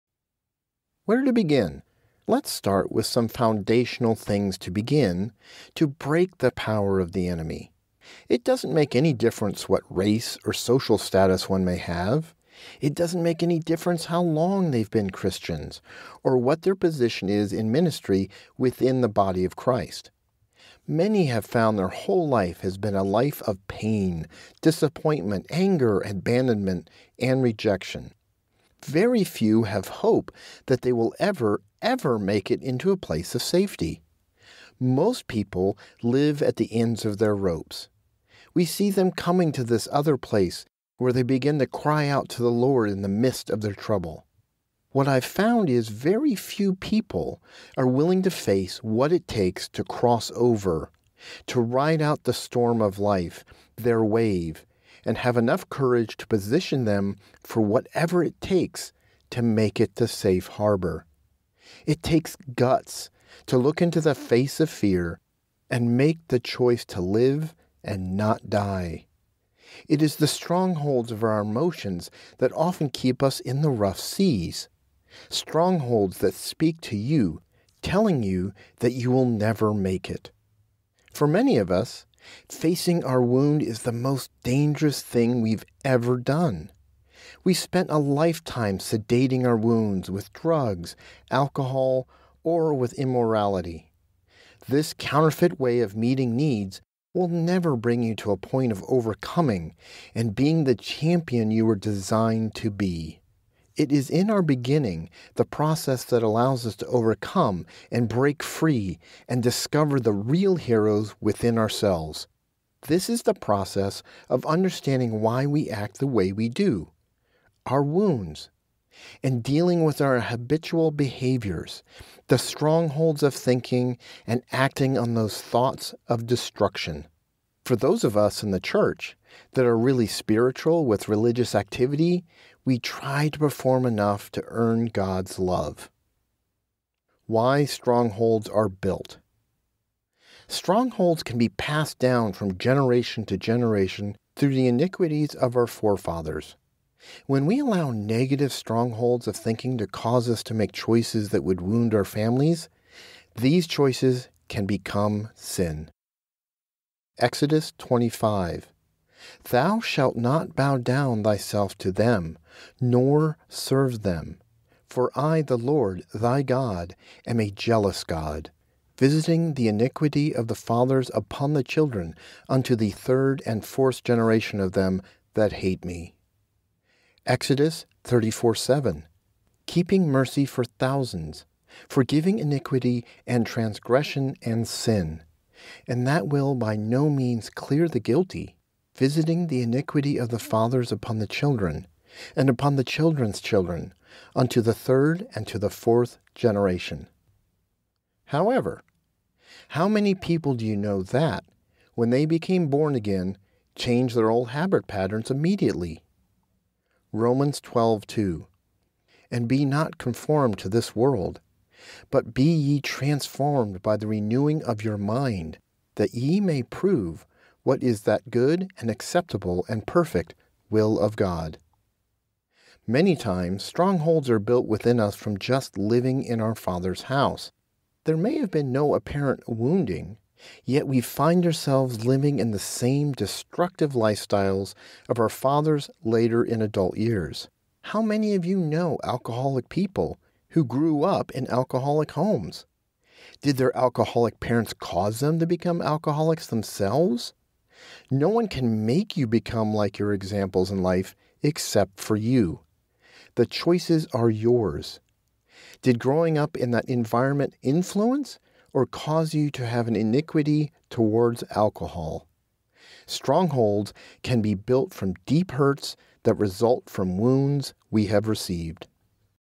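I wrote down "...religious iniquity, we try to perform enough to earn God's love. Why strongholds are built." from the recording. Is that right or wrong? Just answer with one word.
wrong.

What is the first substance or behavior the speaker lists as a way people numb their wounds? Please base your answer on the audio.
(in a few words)
drugs.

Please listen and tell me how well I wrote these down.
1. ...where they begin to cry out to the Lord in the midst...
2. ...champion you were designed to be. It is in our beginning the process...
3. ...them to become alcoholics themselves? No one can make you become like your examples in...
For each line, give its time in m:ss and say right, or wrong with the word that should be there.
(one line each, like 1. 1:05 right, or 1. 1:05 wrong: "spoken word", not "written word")
1. 0:40 right
2. 1:40 right
3. 4:05 right.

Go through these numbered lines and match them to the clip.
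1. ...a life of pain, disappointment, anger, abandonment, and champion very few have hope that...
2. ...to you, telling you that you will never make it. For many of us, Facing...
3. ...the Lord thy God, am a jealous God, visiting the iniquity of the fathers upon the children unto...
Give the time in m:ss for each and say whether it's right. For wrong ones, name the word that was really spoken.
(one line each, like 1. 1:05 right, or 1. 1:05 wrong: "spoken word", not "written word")
1. 0:22 wrong: "rejection", not "champion"
2. 1:16 right
3. 2:45 right.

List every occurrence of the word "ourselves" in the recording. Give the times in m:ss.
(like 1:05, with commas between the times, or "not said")
1:51, 3:51.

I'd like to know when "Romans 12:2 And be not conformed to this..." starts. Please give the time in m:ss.
3:27.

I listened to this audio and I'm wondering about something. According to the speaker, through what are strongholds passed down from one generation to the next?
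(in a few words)
iniquities of our forefathers.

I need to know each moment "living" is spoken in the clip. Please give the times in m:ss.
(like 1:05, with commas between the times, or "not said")
3:45, 3:52.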